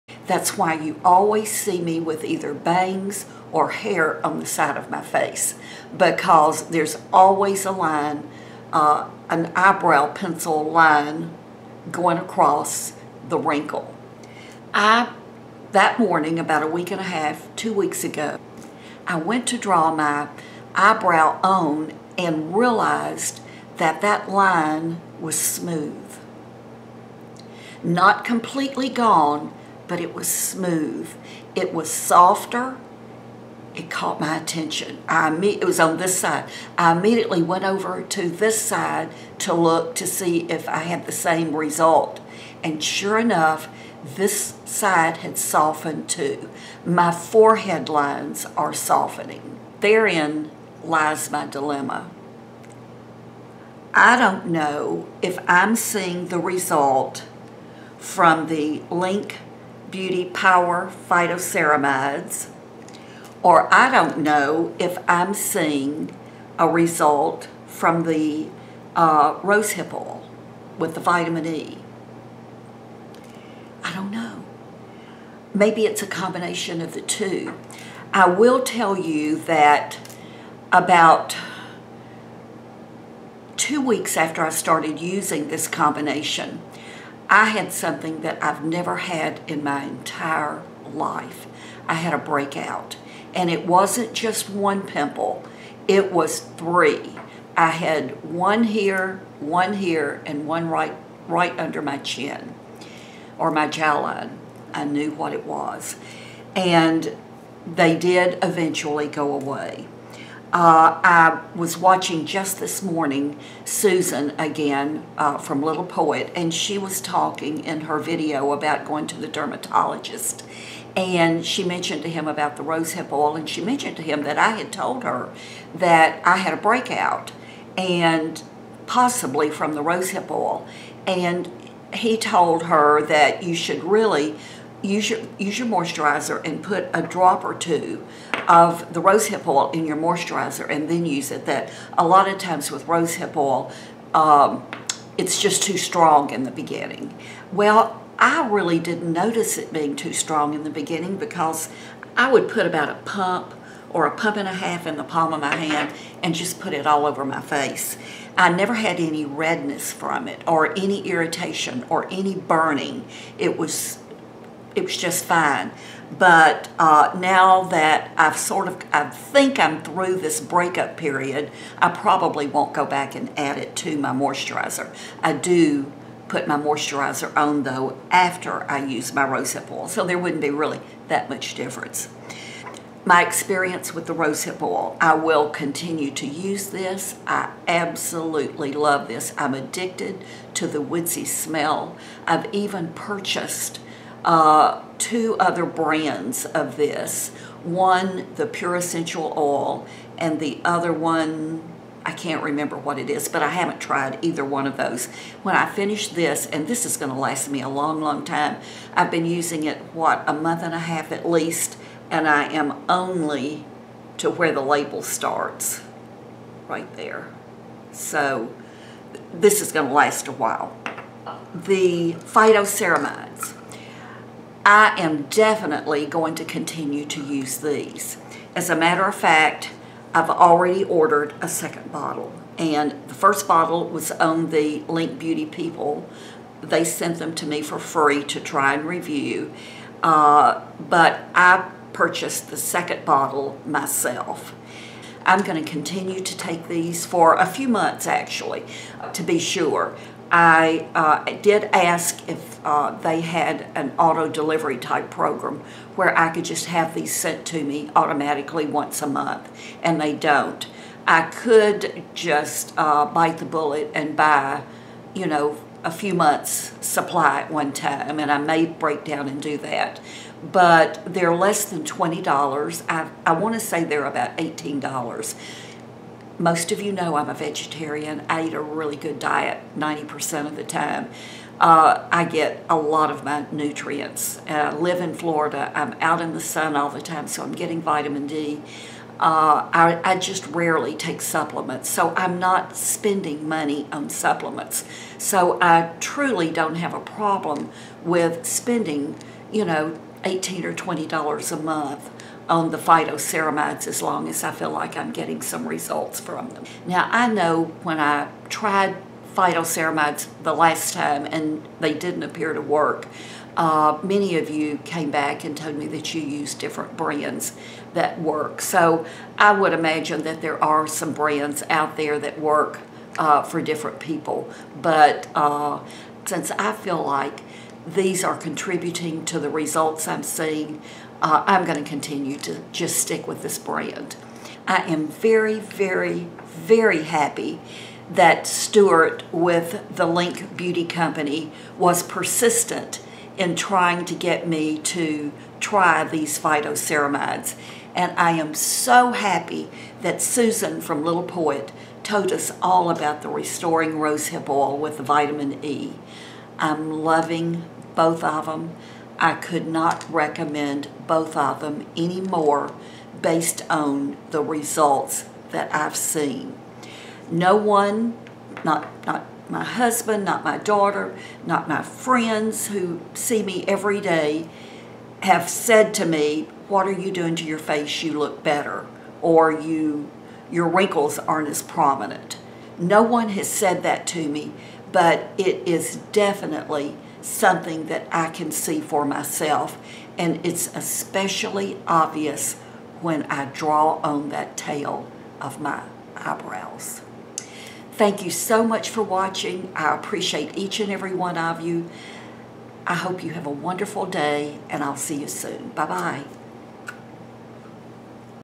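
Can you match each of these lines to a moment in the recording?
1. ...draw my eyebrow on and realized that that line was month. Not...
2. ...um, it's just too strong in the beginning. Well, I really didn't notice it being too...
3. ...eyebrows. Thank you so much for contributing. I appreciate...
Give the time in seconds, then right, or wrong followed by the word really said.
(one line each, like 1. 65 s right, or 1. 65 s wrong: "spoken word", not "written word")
1. 19 s wrong: "smooth", not "month"
2. 144 s right
3. 396 s wrong: "watching", not "contributing".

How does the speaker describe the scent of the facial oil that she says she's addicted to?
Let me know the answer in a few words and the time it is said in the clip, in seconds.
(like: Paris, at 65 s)
Woodsy, at 190 s.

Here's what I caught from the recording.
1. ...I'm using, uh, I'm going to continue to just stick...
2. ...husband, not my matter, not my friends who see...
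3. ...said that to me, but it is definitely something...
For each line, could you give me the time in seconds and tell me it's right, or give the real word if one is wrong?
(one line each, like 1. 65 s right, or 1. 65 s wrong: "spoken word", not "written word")
1. 330 s wrong: "seeing", not "using"
2. 369 s wrong: "daughter", not "matter"
3. 383 s right.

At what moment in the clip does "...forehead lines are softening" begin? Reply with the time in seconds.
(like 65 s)
47 s.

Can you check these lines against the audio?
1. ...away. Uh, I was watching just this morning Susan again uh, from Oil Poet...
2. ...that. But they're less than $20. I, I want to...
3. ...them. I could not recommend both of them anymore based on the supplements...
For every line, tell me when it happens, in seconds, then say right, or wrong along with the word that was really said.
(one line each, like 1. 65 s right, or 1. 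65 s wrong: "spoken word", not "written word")
1. 109 s wrong: "Little", not "Oil"
2. 269 s right
3. 358 s wrong: "results", not "supplements".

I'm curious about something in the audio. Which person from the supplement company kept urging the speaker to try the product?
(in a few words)
Stuart.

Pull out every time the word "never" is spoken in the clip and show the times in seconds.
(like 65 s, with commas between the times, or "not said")
88 s, 158 s.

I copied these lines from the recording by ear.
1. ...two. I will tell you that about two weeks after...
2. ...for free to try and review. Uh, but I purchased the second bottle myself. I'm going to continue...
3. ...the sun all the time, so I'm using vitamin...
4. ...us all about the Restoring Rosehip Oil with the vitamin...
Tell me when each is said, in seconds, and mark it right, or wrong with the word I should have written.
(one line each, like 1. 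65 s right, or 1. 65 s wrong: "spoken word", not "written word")
1. 77 s right
2. 237 s right
3. 286 s wrong: "getting", not "using"
4. 352 s right.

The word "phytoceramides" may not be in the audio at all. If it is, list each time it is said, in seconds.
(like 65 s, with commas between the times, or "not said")
61 s, 222 s, 302 s, 309 s, 346 s.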